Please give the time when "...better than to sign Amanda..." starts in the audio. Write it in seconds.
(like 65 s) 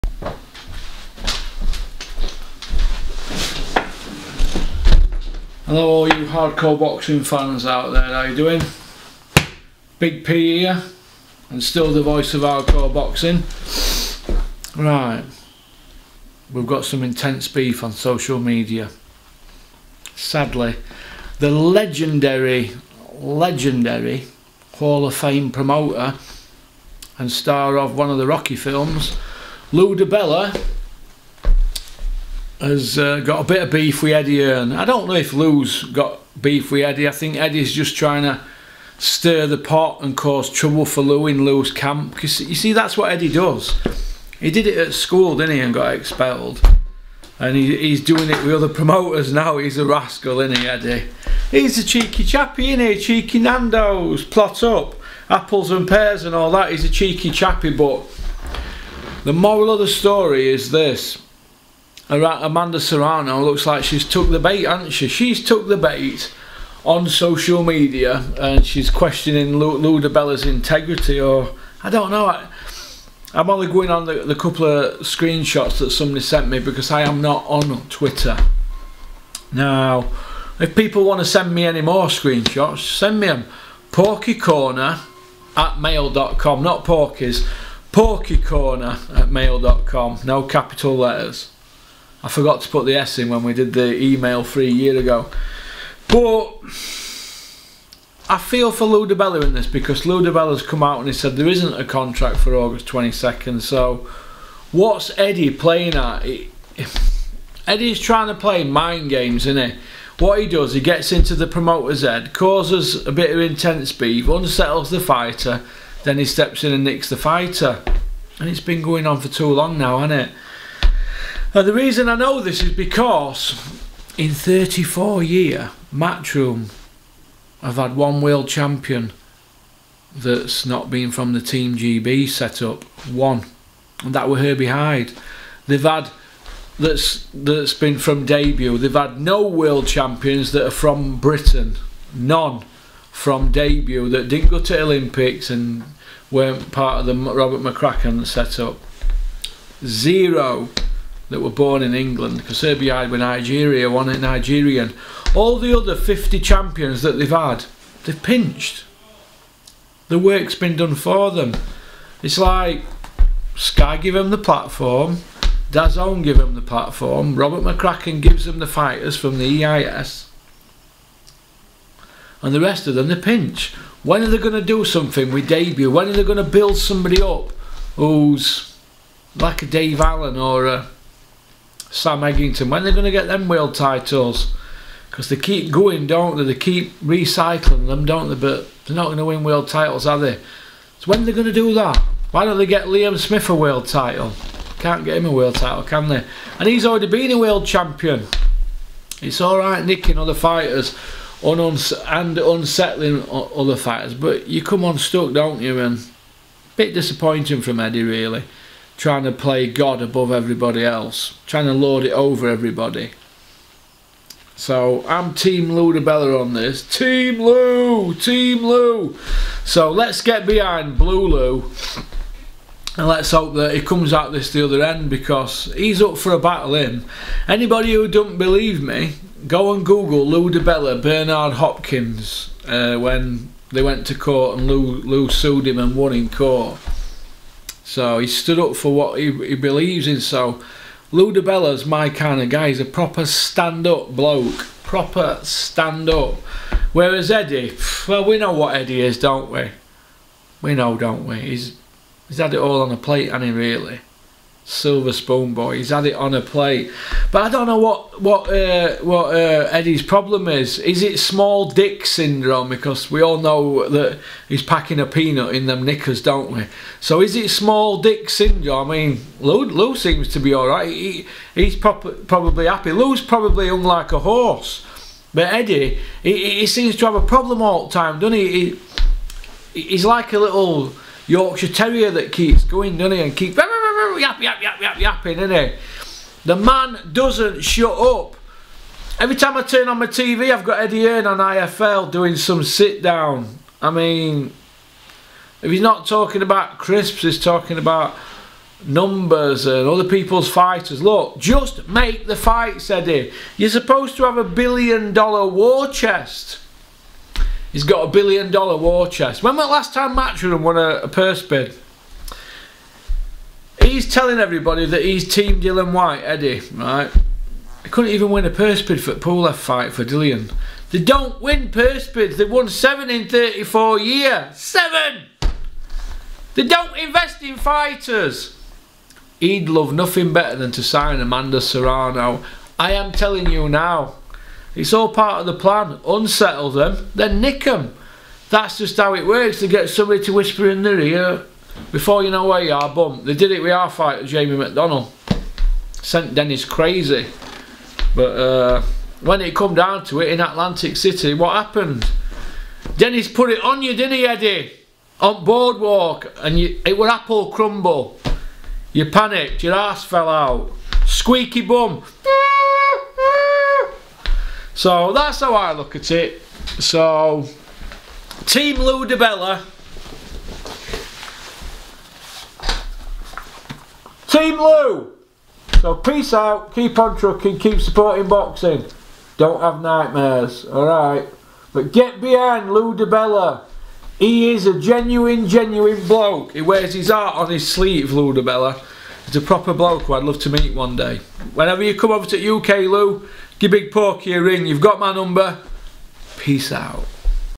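330 s.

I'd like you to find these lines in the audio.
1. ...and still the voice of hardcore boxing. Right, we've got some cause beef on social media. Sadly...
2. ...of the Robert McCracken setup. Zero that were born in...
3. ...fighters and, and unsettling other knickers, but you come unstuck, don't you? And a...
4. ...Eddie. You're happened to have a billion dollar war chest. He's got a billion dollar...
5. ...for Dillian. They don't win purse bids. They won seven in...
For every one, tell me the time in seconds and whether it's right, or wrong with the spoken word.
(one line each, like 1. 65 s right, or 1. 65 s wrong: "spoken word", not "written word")
1. 11 s wrong: "intense", not "cause"
2. 147 s right
3. 200 s wrong: "fighters", not "knickers"
4. 302 s wrong: "supposed", not "happened"
5. 319 s right.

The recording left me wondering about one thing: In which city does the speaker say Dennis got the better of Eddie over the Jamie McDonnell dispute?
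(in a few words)
Atlantic City.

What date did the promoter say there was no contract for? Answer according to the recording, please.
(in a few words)
August 22nd.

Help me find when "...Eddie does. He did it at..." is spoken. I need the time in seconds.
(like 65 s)
43 s.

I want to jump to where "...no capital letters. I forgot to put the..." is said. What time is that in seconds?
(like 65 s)
90 s.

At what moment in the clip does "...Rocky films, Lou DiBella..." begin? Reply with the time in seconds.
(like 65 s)
28 s.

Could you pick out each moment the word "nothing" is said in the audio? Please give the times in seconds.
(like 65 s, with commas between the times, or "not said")
329 s.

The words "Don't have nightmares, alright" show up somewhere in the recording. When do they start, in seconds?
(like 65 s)
379 s.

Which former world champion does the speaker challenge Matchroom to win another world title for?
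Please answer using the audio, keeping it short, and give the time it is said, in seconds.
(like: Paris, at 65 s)
Liam Smith, at 192 s.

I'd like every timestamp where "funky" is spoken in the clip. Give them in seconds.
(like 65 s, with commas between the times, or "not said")
not said.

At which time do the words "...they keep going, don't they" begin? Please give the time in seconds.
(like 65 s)
185 s.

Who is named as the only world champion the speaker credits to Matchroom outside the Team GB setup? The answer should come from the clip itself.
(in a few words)
Herbie Hide.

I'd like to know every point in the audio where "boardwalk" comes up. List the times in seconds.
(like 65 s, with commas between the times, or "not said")
355 s.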